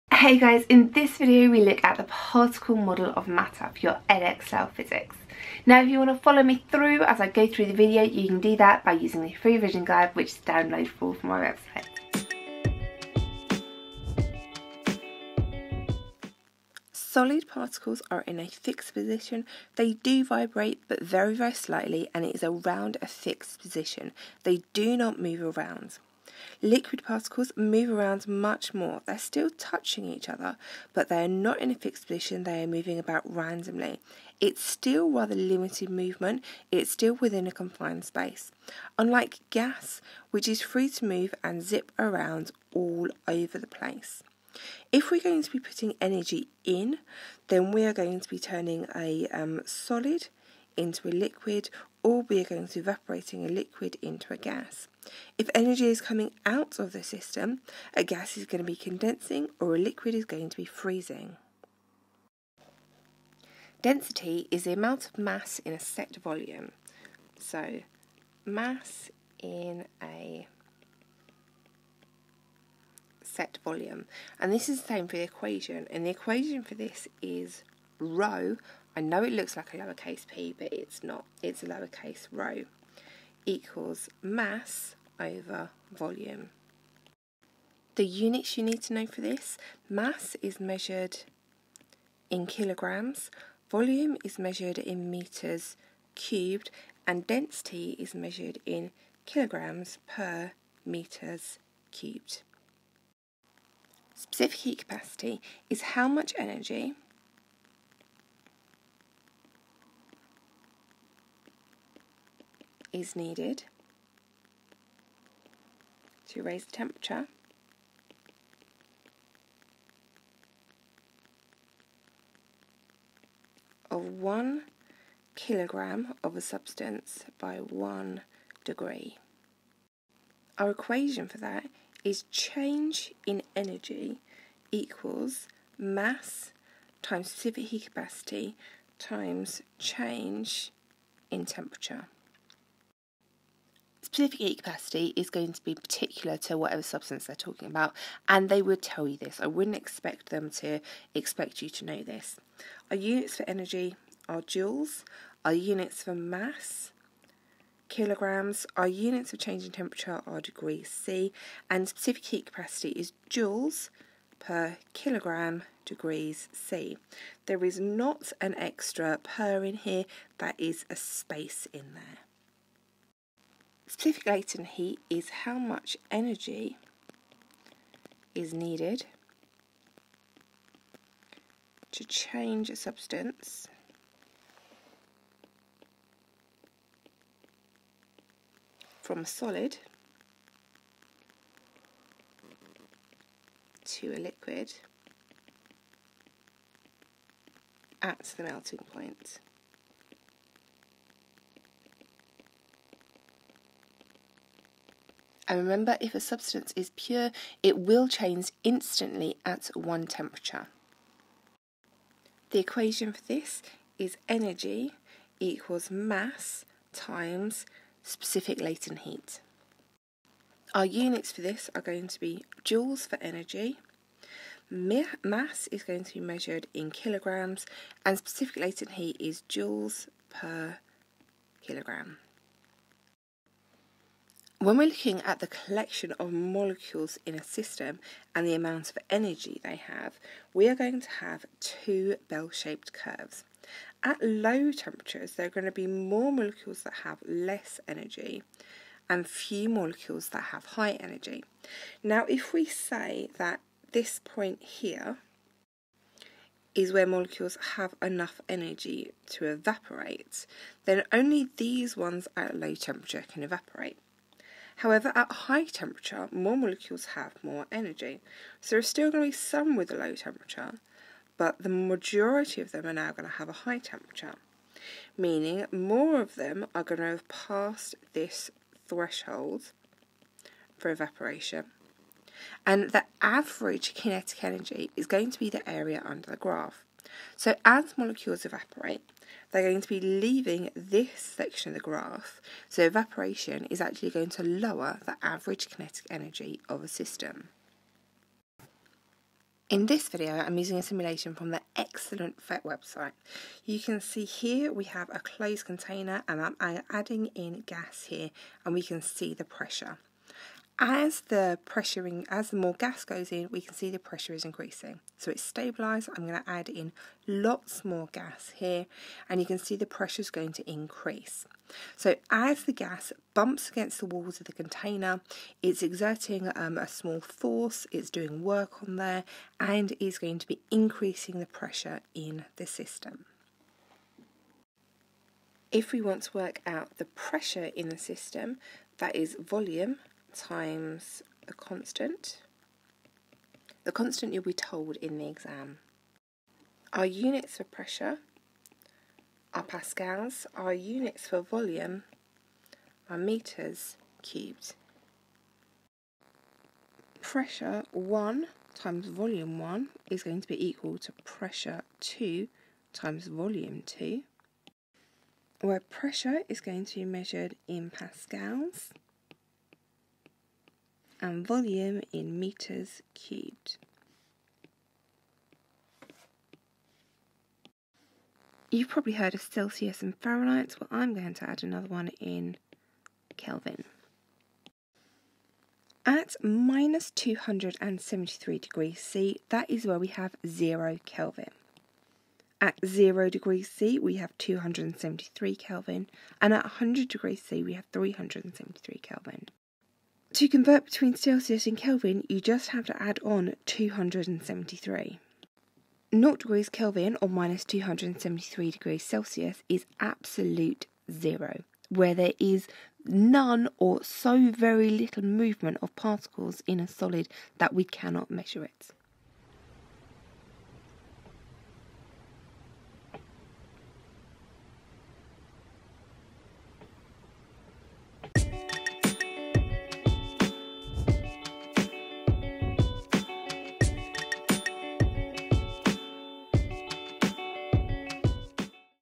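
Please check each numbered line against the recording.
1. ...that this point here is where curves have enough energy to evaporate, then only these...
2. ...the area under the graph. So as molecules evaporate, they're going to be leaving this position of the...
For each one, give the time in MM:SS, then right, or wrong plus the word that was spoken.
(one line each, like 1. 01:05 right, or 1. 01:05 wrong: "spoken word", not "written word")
1. 04:13 wrong: "molecules", not "curves"
2. 04:45 wrong: "section", not "position".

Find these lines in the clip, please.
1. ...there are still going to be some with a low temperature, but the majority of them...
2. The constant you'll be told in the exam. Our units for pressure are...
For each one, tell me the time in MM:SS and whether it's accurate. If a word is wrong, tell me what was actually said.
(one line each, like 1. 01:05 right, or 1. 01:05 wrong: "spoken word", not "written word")
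1. 04:28 right
2. 05:43 right.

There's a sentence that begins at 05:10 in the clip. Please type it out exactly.
As the pressuring, as the more gas goes in, we can see the pressure is increasing.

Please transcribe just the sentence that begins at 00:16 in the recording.
Solid particles are in a fixed position.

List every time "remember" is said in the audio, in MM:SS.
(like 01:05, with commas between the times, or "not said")
03:25.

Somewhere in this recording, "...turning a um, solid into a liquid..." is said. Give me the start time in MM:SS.
00:48.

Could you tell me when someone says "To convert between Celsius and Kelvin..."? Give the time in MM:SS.
06:40.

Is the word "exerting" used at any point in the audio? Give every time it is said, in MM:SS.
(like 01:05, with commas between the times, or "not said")
05:25.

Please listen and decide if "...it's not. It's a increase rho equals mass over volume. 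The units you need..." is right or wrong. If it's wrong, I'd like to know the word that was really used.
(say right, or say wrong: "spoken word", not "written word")
wrong: "lowercase", not "increase".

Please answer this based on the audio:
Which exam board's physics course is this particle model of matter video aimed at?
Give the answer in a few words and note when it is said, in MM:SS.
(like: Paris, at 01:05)
Edexcel, at 00:04.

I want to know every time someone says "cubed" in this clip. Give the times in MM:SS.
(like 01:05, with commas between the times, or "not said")
01:36, 01:41, 05:54, 06:13.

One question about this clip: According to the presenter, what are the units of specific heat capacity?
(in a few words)
joules per kilogram degrees C.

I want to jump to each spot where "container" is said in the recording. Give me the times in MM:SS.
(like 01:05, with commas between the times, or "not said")
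05:05, 05:24.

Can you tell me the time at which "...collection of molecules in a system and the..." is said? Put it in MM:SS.
03:55.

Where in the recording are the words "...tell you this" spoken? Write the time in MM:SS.
02:28.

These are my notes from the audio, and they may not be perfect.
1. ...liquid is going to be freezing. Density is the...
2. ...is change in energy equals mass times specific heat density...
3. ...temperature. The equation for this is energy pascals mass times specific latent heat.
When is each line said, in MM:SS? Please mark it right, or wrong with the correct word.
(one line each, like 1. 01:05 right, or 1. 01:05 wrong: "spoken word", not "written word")
1. 00:59 right
2. 02:12 wrong: "capacity", not "density"
3. 03:30 wrong: "equals", not "pascals".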